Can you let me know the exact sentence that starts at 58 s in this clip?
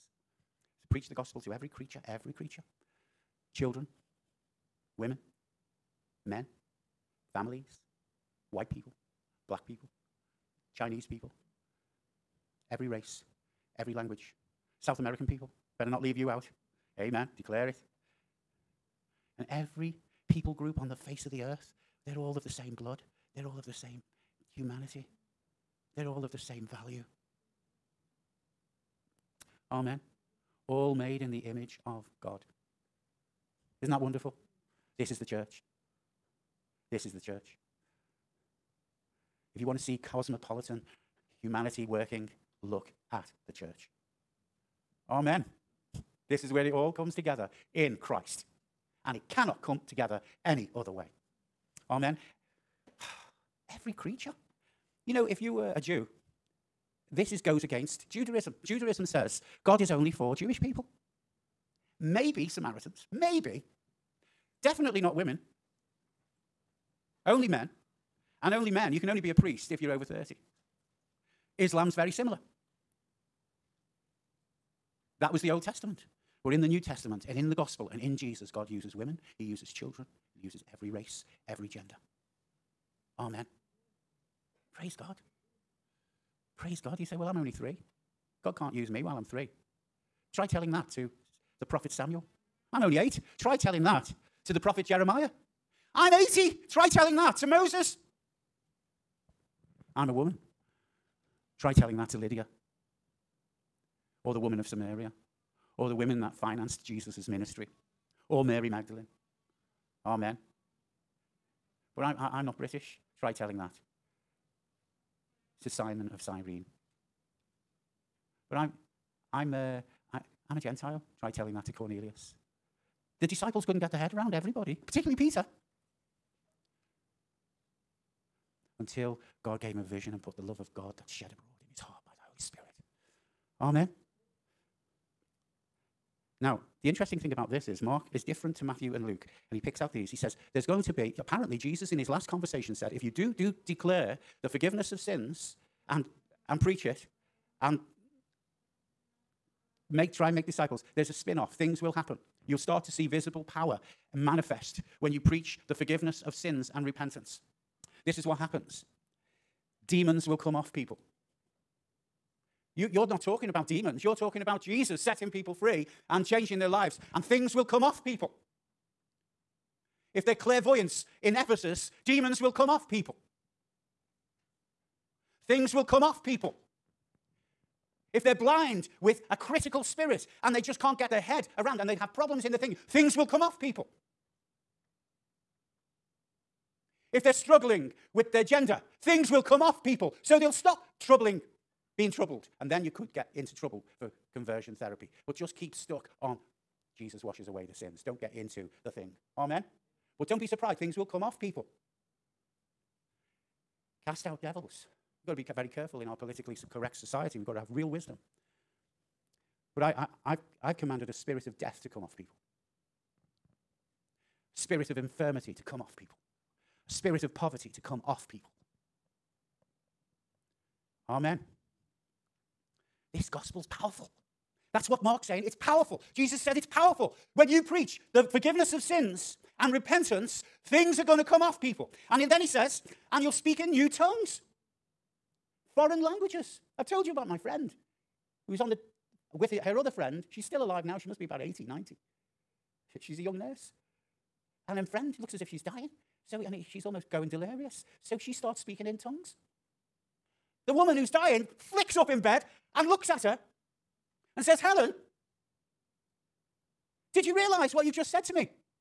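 Judaism says God is only for Jewish people.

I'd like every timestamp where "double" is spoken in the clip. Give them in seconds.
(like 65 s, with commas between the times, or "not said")
not said.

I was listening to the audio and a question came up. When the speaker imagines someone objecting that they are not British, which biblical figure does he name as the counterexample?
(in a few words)
Simon of Cyrene.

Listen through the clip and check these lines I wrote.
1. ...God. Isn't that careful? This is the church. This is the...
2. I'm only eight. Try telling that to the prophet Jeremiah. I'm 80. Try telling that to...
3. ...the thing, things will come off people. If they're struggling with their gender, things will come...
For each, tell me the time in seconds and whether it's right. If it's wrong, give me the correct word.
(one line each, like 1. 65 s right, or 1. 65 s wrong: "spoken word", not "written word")
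1. 32 s wrong: "wonderful", not "careful"
2. 92 s right
3. 182 s right.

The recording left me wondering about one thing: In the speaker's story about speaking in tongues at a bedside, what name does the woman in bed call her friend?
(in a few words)
Helen.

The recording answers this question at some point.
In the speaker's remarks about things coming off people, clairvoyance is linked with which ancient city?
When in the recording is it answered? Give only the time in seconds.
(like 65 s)
171 s.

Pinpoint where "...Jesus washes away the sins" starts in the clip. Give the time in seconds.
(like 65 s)
196 s.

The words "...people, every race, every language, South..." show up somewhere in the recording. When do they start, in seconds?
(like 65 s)
11 s.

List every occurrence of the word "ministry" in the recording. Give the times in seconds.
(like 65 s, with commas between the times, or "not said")
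107 s.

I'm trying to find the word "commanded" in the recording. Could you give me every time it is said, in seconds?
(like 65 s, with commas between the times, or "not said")
210 s.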